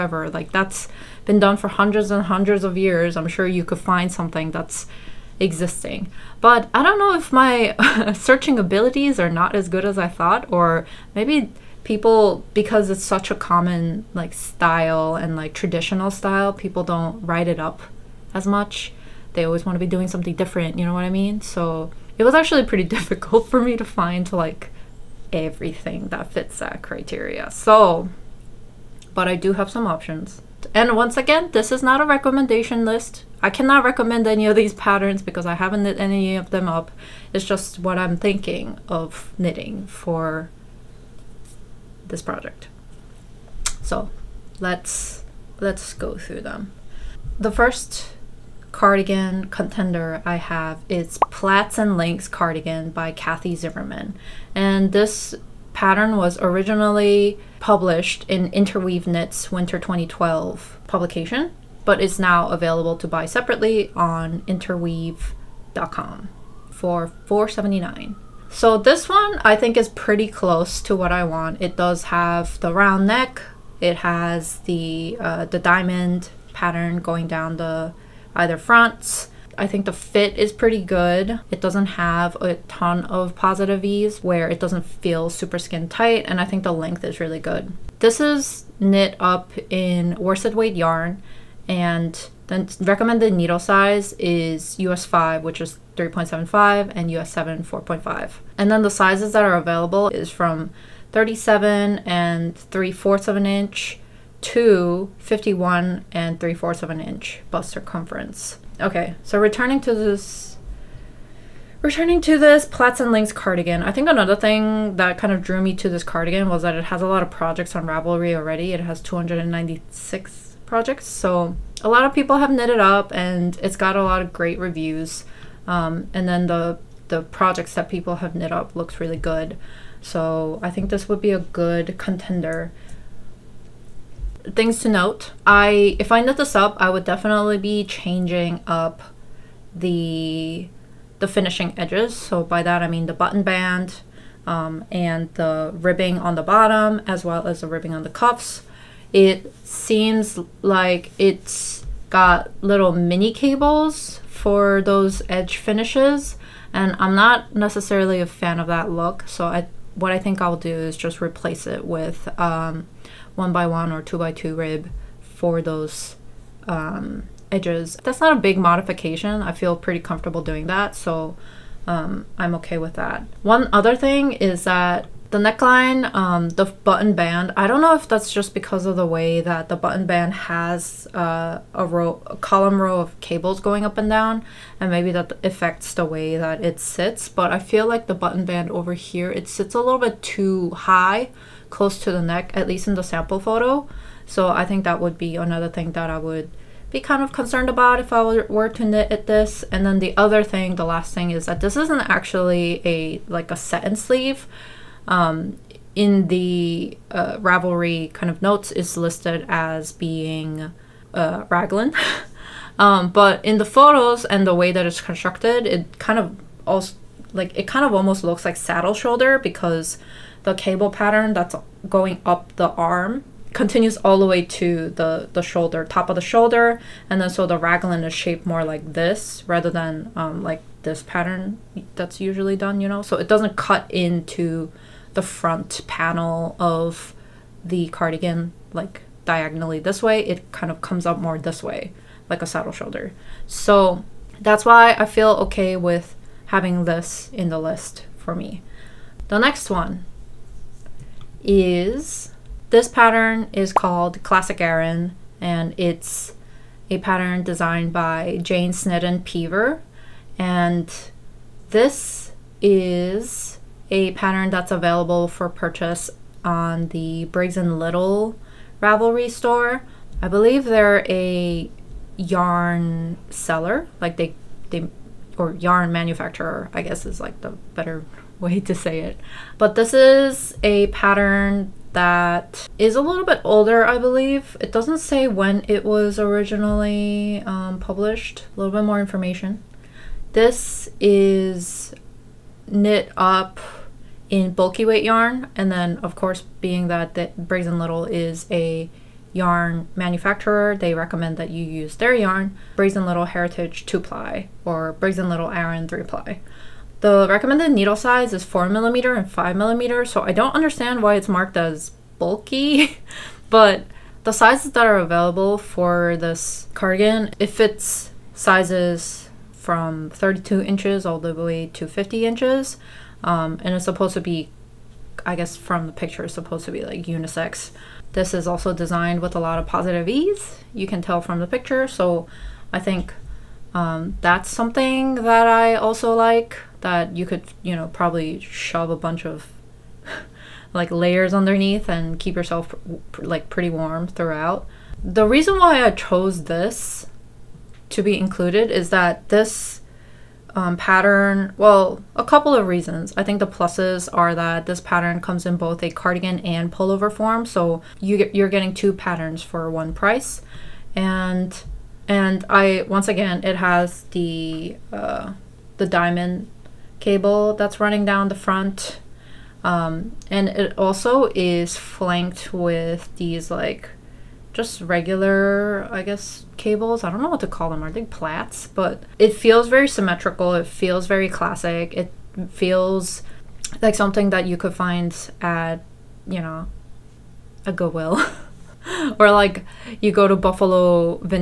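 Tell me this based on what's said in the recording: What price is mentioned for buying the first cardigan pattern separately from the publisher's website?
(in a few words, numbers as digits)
4.79.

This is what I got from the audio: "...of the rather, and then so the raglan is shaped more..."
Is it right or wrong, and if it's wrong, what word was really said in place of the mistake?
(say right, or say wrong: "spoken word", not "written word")
wrong: "shoulder", not "rather".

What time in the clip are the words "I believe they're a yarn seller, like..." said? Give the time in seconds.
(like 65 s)
270 s.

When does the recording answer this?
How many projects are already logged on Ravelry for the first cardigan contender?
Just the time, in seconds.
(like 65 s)
119 s.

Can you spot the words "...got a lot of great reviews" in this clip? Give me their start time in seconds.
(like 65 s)
123 s.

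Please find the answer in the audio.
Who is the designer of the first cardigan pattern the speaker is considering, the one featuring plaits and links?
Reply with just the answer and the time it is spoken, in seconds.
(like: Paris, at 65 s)
Kathy Zimmerman, at 53 s.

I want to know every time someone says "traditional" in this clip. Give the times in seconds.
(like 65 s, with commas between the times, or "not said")
15 s.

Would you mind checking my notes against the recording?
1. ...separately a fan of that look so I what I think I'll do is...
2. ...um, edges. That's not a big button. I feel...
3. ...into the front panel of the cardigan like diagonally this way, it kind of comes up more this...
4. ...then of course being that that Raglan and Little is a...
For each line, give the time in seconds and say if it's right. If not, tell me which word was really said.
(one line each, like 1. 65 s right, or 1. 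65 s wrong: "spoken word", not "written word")
1. 157 s wrong: "necessarily", not "separately"
2. 166 s wrong: "modification", not "button"
3. 233 s right
4. 295 s wrong: "Briggs", not "Raglan".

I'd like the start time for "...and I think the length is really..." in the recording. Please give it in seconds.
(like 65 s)
86 s.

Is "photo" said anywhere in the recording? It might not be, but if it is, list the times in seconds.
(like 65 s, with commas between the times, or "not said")
193 s, 213 s.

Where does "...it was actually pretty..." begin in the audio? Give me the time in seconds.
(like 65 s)
22 s.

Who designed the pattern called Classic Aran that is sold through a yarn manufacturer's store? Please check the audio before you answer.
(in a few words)
Jane Snedden Peever.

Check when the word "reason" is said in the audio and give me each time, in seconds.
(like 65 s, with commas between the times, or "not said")
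345 s, 352 s.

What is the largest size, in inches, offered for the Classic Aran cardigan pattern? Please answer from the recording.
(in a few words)
50 inches.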